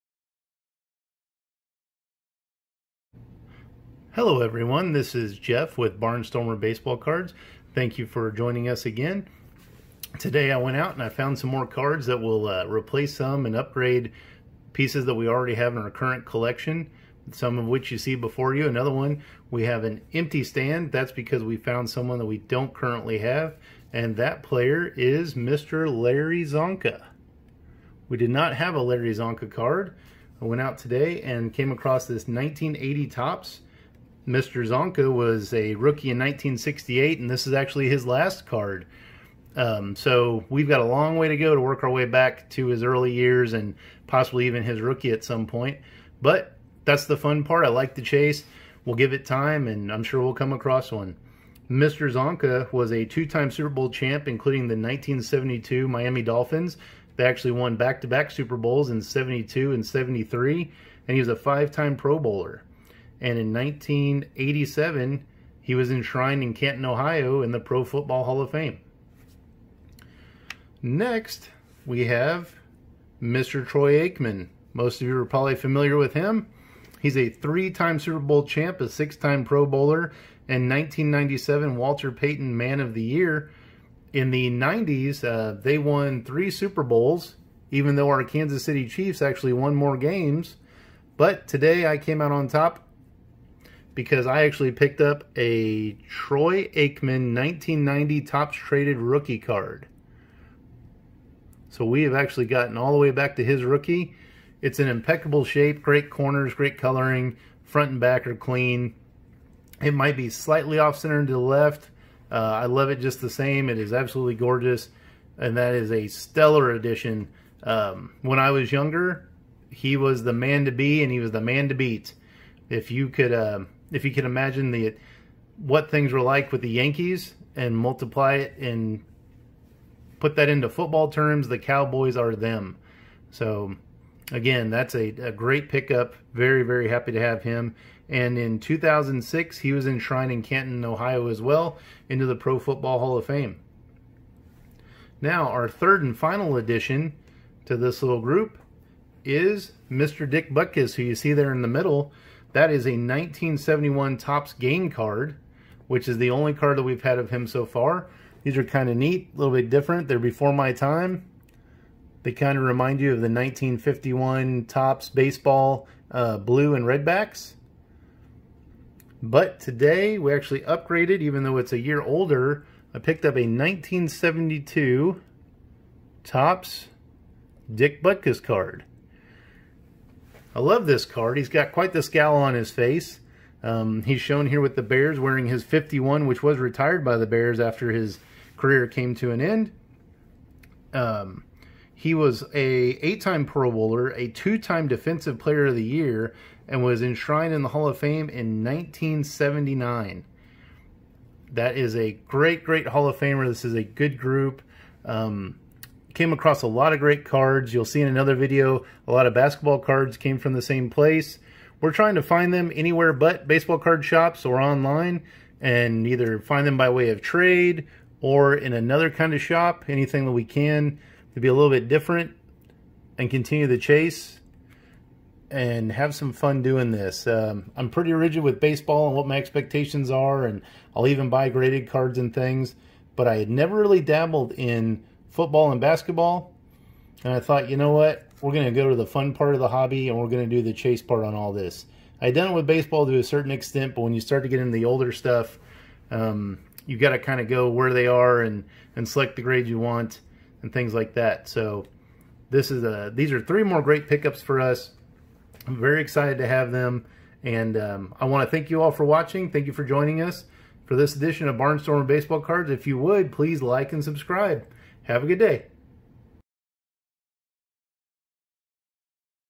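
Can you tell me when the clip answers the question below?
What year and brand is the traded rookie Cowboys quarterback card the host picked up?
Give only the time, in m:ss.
1:37.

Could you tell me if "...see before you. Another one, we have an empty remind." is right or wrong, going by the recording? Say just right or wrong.
wrong.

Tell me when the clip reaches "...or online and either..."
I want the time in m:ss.
3:34.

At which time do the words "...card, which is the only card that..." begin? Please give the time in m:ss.
2:34.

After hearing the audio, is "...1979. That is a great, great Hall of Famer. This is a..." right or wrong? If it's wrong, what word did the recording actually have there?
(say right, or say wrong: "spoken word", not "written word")
right.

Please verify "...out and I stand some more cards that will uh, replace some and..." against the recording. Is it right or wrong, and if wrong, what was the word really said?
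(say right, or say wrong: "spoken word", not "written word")
wrong: "found", not "stand".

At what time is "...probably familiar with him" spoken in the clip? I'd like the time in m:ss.
1:15.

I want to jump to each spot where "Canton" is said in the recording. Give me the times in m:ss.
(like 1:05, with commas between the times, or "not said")
1:06, 2:20.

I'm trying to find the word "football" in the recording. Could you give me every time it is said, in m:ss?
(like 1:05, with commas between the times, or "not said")
1:07, 2:10, 2:22, 3:55.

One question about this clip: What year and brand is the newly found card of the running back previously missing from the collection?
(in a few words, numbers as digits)
1980 Topps.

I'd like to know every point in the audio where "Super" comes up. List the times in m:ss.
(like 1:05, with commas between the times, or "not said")
0:53, 0:58, 1:17, 1:26.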